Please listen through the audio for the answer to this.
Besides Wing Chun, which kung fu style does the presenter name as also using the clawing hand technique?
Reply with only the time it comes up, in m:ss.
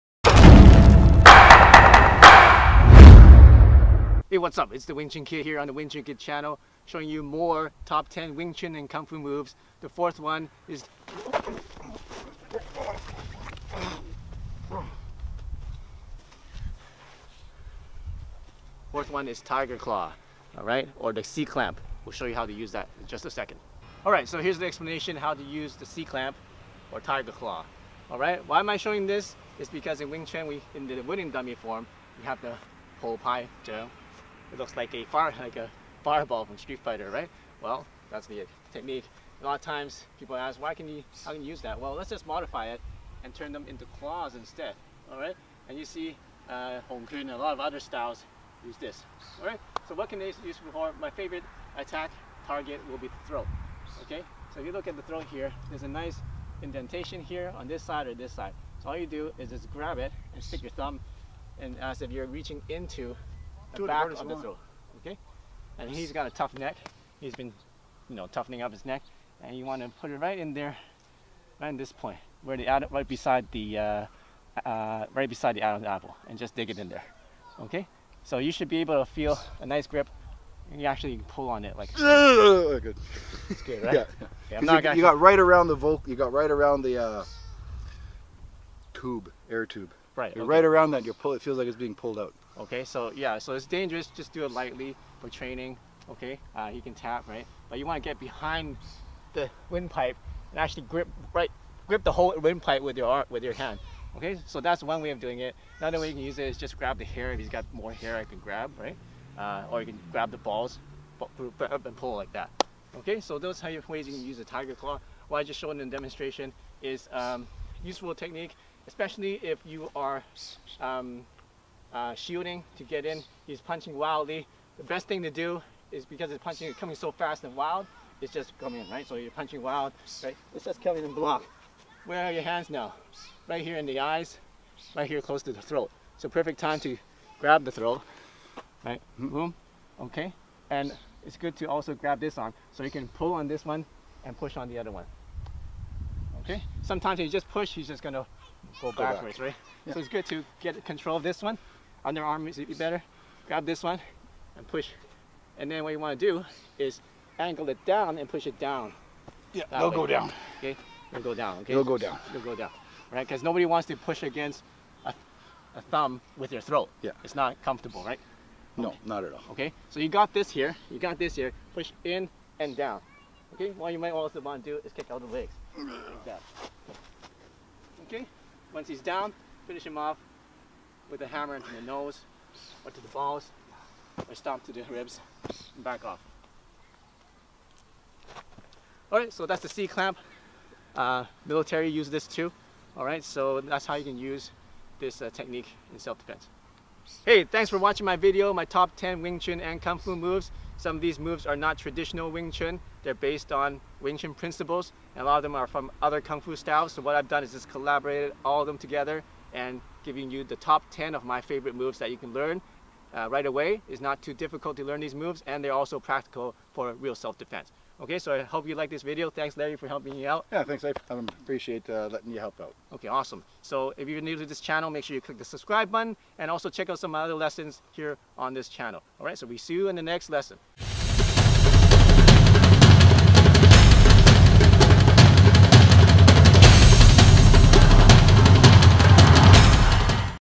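0:46.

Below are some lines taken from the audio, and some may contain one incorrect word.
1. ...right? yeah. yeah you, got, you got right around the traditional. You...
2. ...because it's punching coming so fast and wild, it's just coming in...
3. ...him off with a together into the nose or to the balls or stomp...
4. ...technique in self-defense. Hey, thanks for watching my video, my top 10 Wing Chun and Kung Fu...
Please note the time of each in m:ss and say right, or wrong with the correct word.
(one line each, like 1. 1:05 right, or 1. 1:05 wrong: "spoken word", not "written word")
1. 1:23 wrong: "vocal", not "traditional"
2. 2:06 right
3. 2:59 wrong: "hammer", not "together"
4. 3:15 right.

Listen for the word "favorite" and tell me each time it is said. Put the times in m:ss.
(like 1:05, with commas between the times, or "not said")
0:51, 3:31.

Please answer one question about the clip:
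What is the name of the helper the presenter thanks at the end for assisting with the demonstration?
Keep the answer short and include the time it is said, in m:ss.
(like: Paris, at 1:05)
Larry, at 3:39.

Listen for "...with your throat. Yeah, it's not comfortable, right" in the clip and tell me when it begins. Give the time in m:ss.
2:46.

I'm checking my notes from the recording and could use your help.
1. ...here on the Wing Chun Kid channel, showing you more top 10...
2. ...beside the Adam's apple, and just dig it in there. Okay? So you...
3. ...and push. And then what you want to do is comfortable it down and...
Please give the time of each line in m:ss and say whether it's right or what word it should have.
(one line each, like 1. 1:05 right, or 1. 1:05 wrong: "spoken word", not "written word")
1. 0:05 right
2. 1:15 right
3. 2:34 wrong: "angle", not "comfortable".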